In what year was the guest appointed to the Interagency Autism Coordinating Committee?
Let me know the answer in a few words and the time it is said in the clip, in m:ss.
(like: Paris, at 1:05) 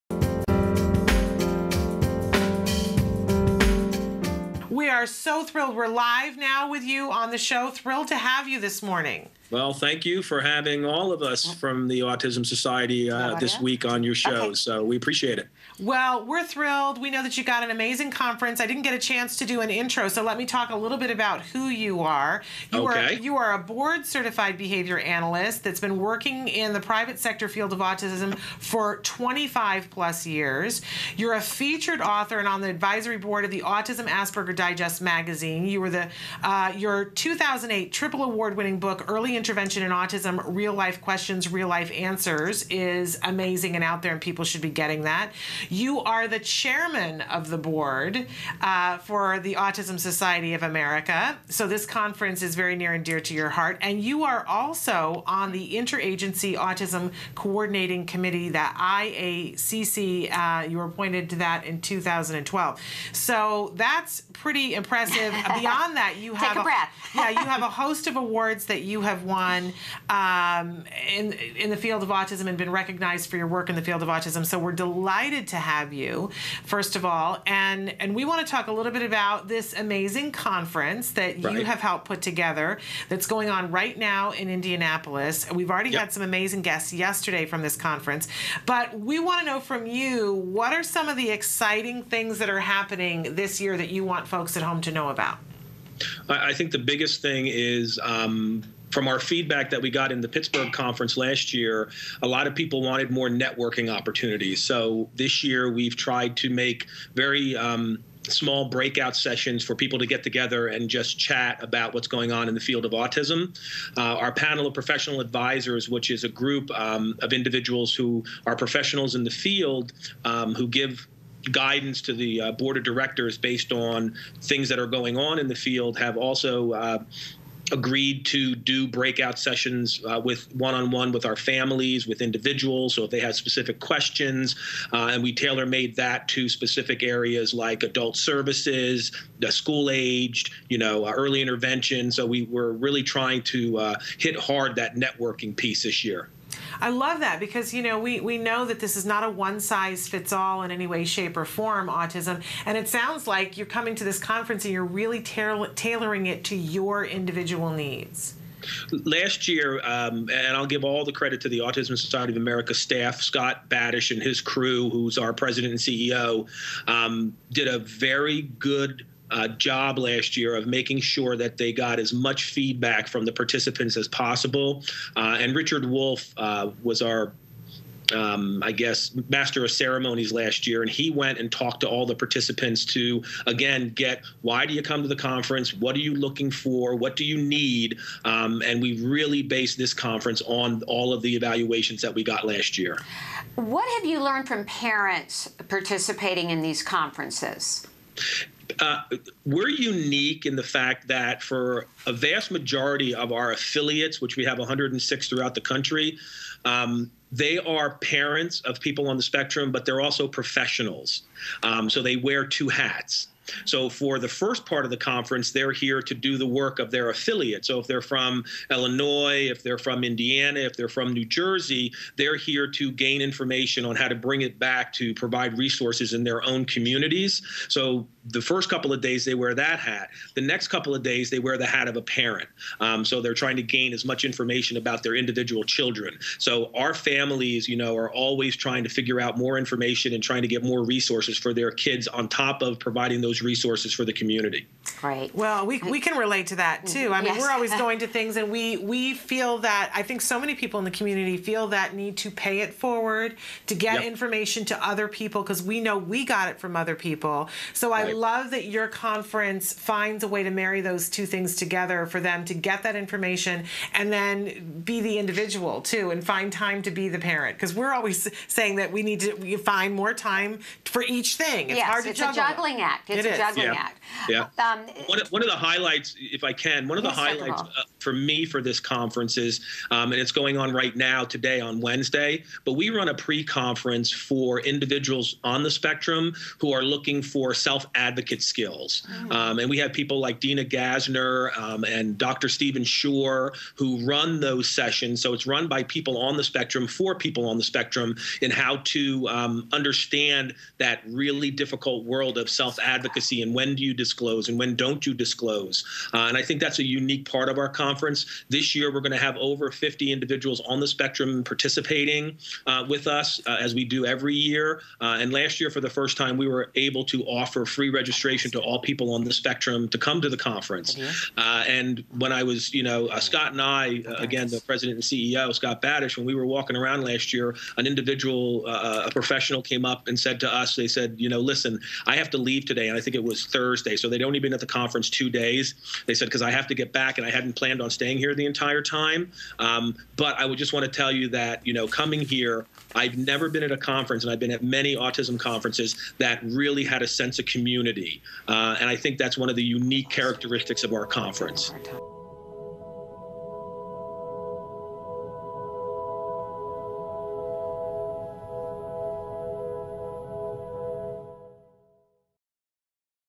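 2012, at 1:01.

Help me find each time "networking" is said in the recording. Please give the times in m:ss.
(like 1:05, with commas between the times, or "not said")
1:43, 2:24.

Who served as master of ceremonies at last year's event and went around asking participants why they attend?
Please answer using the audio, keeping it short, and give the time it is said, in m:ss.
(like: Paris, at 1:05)
Richard Wolf, at 2:55.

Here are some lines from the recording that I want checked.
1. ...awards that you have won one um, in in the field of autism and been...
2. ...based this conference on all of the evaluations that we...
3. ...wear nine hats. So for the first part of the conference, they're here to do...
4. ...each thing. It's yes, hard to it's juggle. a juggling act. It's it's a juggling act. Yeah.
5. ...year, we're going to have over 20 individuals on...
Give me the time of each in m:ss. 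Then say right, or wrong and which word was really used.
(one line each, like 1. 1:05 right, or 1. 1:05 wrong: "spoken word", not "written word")
1. 1:08 right
2. 3:09 right
3. 3:32 wrong: "two", not "nine"
4. 4:31 right
5. 5:08 wrong: "50", not "20".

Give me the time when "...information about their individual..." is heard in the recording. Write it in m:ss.
3:54.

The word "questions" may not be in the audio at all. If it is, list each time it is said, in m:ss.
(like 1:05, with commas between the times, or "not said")
0:41, 2:13.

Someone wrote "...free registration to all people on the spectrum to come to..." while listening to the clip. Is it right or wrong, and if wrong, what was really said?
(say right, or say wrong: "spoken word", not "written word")
right.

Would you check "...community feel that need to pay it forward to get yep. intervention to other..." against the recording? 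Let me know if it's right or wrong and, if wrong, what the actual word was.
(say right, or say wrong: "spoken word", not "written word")
wrong: "information", not "intervention".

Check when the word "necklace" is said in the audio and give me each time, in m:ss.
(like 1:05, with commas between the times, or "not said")
not said.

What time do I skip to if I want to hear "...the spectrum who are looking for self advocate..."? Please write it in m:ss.
4:45.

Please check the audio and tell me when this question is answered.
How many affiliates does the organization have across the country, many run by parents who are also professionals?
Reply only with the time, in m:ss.
3:24.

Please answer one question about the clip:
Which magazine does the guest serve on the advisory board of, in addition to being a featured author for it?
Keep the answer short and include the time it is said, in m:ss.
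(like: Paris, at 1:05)
Autism Asperger Digest, at 0:33.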